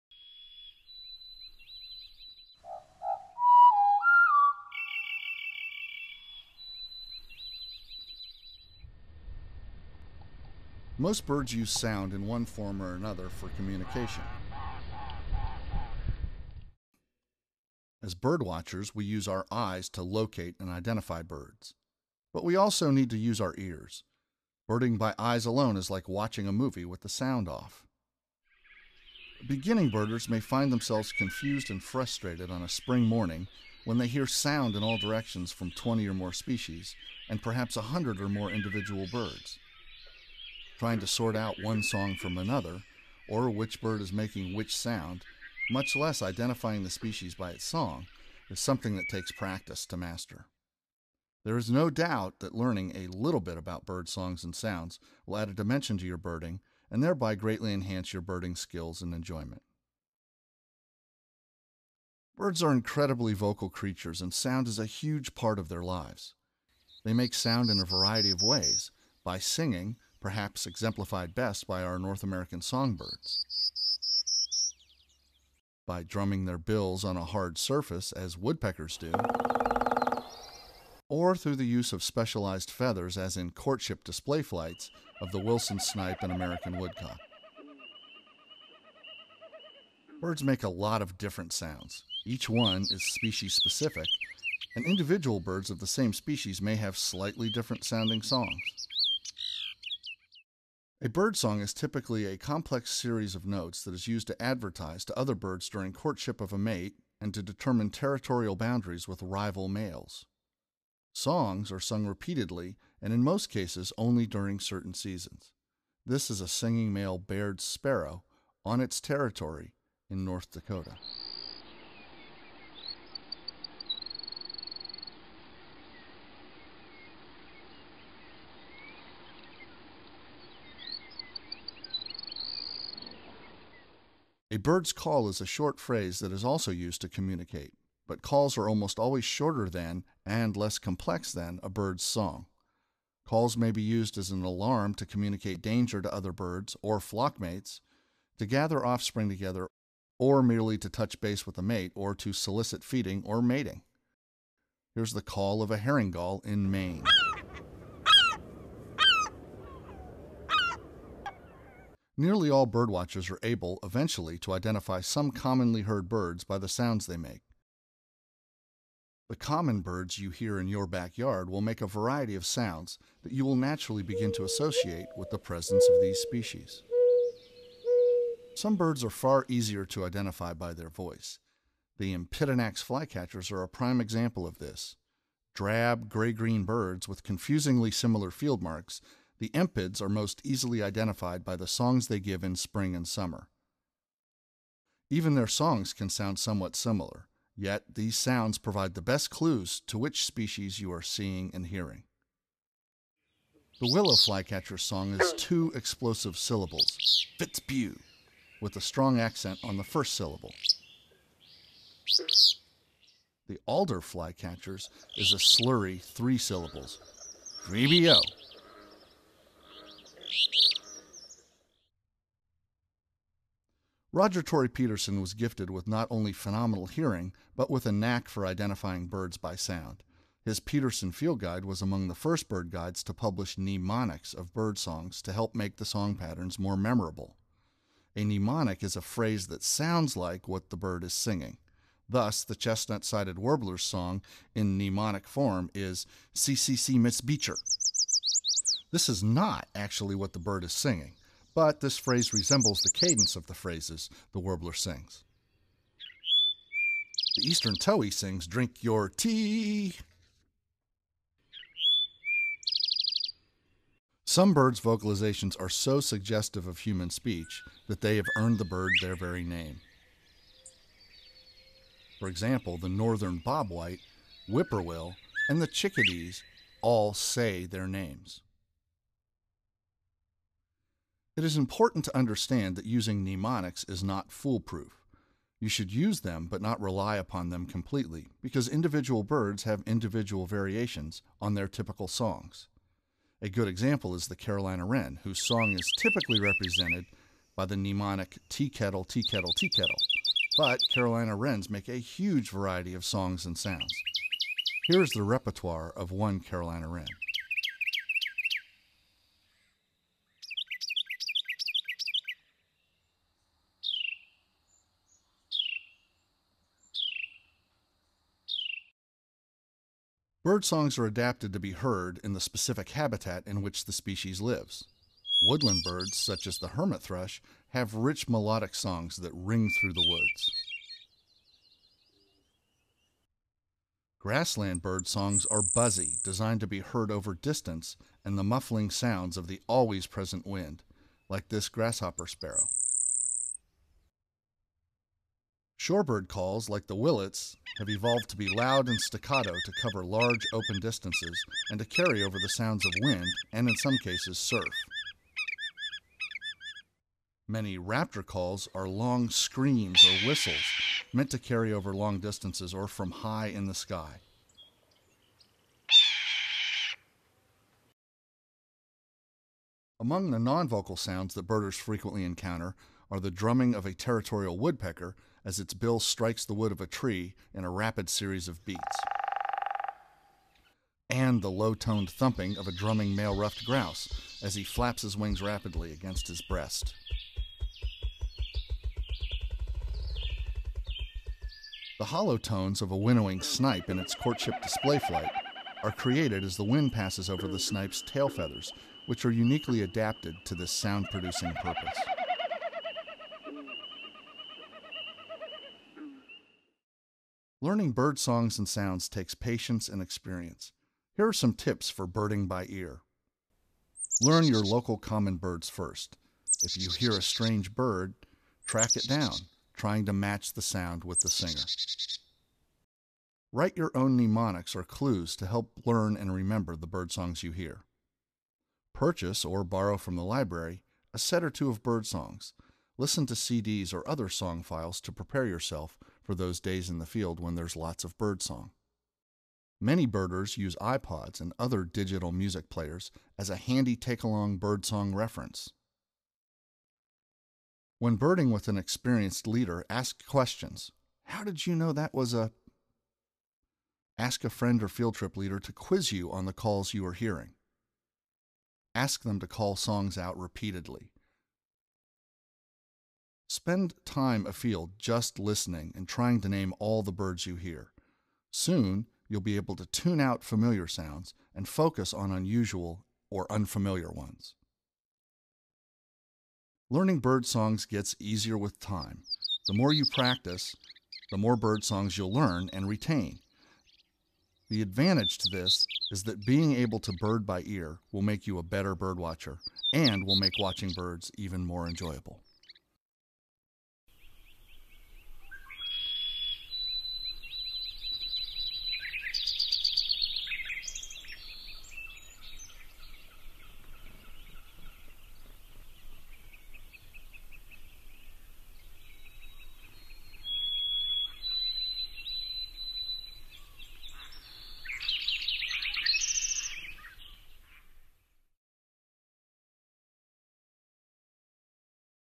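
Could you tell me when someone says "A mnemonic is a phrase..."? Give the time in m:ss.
3:58.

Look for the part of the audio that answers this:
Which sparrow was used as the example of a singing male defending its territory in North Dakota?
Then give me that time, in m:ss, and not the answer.
1:57.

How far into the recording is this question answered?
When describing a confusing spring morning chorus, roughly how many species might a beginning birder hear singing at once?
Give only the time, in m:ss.
0:35.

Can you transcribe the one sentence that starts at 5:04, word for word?
Here is the repertoire of one Carolina wren.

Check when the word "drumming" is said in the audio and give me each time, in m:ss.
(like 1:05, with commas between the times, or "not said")
1:16, 6:13, 6:22.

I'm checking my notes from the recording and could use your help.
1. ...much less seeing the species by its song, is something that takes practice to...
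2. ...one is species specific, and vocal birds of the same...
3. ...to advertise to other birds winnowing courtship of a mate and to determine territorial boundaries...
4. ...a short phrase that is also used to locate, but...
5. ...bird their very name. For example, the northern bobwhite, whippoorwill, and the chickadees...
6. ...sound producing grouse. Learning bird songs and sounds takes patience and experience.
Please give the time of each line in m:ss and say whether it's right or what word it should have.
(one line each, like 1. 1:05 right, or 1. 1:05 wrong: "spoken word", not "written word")
1. 0:45 wrong: "identifying", not "seeing"
2. 1:32 wrong: "individual", not "vocal"
3. 1:44 wrong: "during", not "winnowing"
4. 2:15 wrong: "communicate", not "locate"
5. 4:28 right
6. 6:40 wrong: "purpose", not "grouse".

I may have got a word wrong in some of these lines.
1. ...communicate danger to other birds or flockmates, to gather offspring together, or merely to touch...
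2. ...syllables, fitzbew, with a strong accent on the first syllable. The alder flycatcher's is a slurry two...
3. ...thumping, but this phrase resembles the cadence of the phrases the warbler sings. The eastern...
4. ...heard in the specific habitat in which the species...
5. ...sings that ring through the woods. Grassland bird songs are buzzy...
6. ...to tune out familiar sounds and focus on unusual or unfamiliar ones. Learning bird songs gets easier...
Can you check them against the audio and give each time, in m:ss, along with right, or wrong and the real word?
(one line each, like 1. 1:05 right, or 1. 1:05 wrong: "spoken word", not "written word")
1. 2:25 right
2. 3:26 wrong: "three", not "two"
3. 4:10 wrong: "singing", not "thumping"
4. 5:21 right
5. 5:28 wrong: "songs", not "sings"
6. 7:49 right.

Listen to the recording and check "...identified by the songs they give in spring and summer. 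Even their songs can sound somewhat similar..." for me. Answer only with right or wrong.
right.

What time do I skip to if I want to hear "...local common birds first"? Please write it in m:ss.
6:54.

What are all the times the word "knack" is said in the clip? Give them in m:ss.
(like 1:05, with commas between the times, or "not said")
3:47.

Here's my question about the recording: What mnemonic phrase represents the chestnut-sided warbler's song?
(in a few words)
CCC Miss Beecher.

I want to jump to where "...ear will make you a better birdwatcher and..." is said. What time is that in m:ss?
8:07.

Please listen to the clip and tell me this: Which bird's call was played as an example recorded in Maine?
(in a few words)
herring gull.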